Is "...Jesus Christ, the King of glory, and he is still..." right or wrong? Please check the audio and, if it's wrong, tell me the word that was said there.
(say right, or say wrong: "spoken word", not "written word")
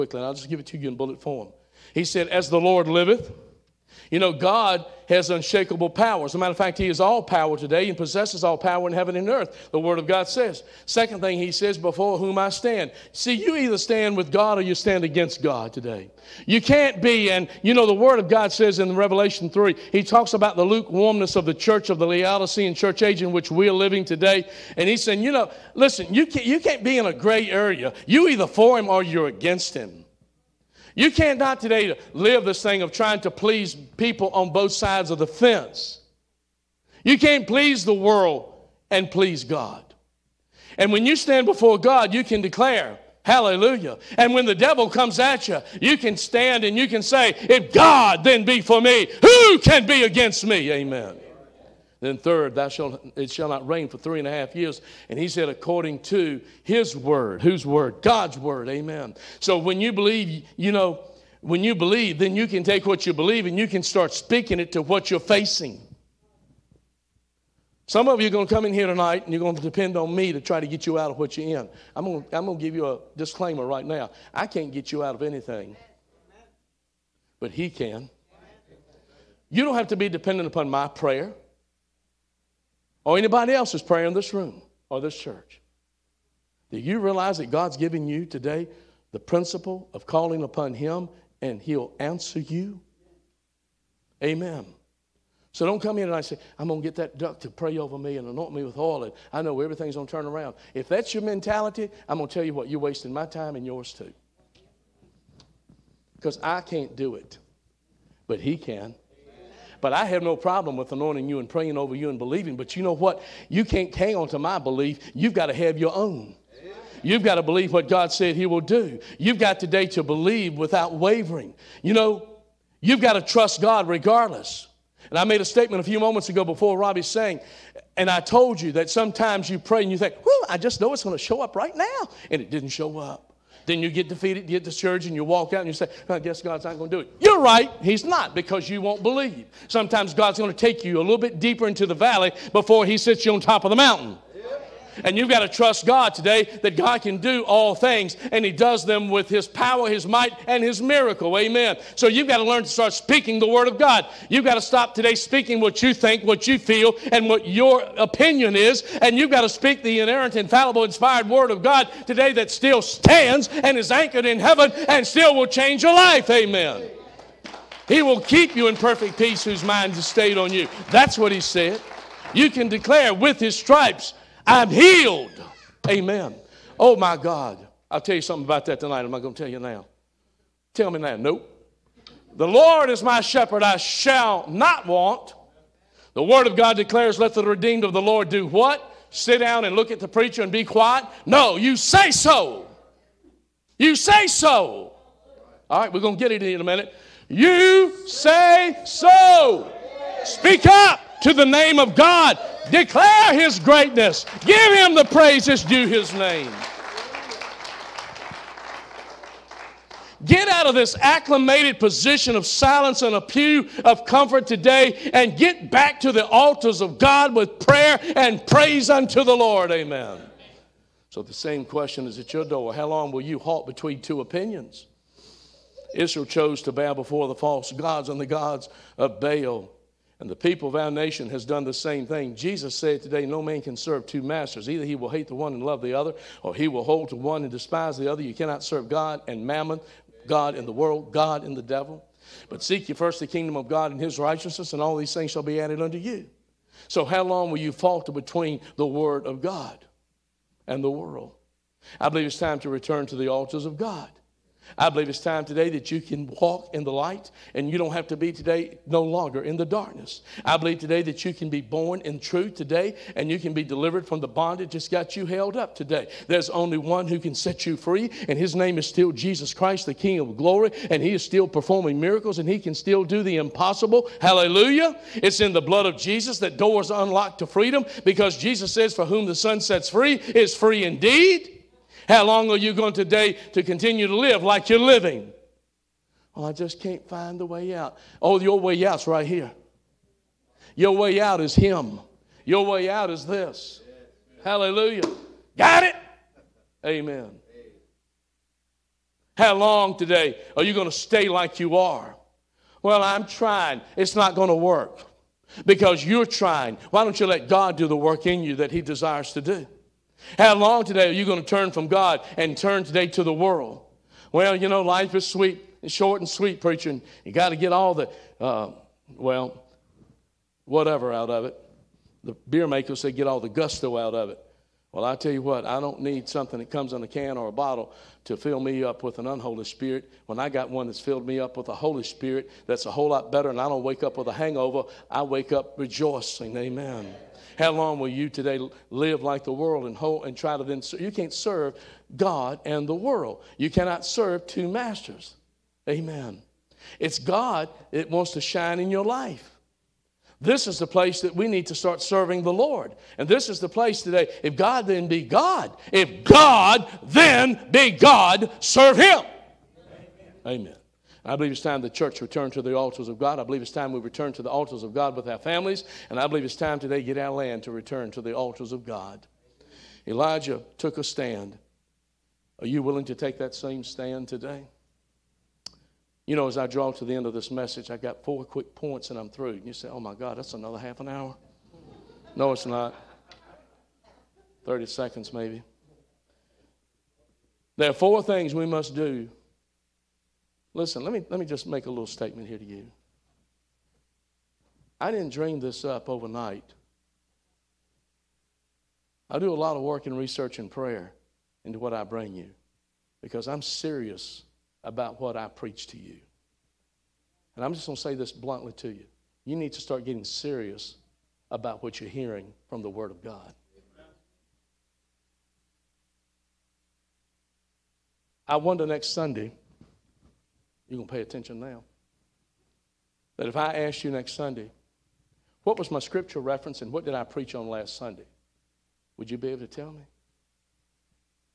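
right.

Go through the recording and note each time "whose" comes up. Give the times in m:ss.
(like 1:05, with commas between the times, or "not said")
0:57, 2:49.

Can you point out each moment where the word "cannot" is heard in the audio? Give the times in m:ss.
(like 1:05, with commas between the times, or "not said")
3:58, 5:43.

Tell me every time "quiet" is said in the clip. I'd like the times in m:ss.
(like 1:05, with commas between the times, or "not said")
3:10.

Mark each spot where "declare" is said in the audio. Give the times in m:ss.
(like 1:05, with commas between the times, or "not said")
0:42, 2:52, 3:06, 3:22.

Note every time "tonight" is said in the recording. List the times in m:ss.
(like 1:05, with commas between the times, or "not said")
1:08, 2:58.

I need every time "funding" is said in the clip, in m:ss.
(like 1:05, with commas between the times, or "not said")
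not said.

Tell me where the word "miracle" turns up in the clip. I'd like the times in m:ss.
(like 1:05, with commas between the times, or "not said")
2:30, 4:32.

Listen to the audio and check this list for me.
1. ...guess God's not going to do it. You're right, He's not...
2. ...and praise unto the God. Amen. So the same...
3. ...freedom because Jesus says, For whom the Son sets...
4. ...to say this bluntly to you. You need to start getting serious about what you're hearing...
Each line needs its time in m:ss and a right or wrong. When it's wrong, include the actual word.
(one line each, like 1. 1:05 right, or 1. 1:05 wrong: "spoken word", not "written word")
1. 2:16 right
2. 3:38 wrong: "Lord", not "God"
3. 4:37 right
4. 6:47 right.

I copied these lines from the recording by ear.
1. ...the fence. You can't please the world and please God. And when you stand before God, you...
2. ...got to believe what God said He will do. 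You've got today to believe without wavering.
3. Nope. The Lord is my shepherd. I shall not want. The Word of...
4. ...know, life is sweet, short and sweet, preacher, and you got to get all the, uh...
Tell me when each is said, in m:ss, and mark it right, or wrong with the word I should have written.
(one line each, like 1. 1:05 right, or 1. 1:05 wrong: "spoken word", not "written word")
1. 0:35 right
2. 1:57 right
3. 3:01 right
4. 5:14 right.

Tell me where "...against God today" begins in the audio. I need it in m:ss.
0:15.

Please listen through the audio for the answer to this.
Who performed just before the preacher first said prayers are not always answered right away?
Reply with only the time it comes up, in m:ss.
2:06.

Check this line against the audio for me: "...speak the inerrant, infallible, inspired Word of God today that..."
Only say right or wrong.
right.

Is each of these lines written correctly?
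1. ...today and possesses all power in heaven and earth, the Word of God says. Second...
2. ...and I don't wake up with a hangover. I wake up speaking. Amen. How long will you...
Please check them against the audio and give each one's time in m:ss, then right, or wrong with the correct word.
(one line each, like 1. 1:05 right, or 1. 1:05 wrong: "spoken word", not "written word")
1. 0:07 right
2. 5:33 wrong: "rejoicing", not "speaking".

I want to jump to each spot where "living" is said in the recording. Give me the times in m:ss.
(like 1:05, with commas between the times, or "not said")
0:23, 4:44.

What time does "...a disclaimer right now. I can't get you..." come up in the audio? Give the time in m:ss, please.
1:12.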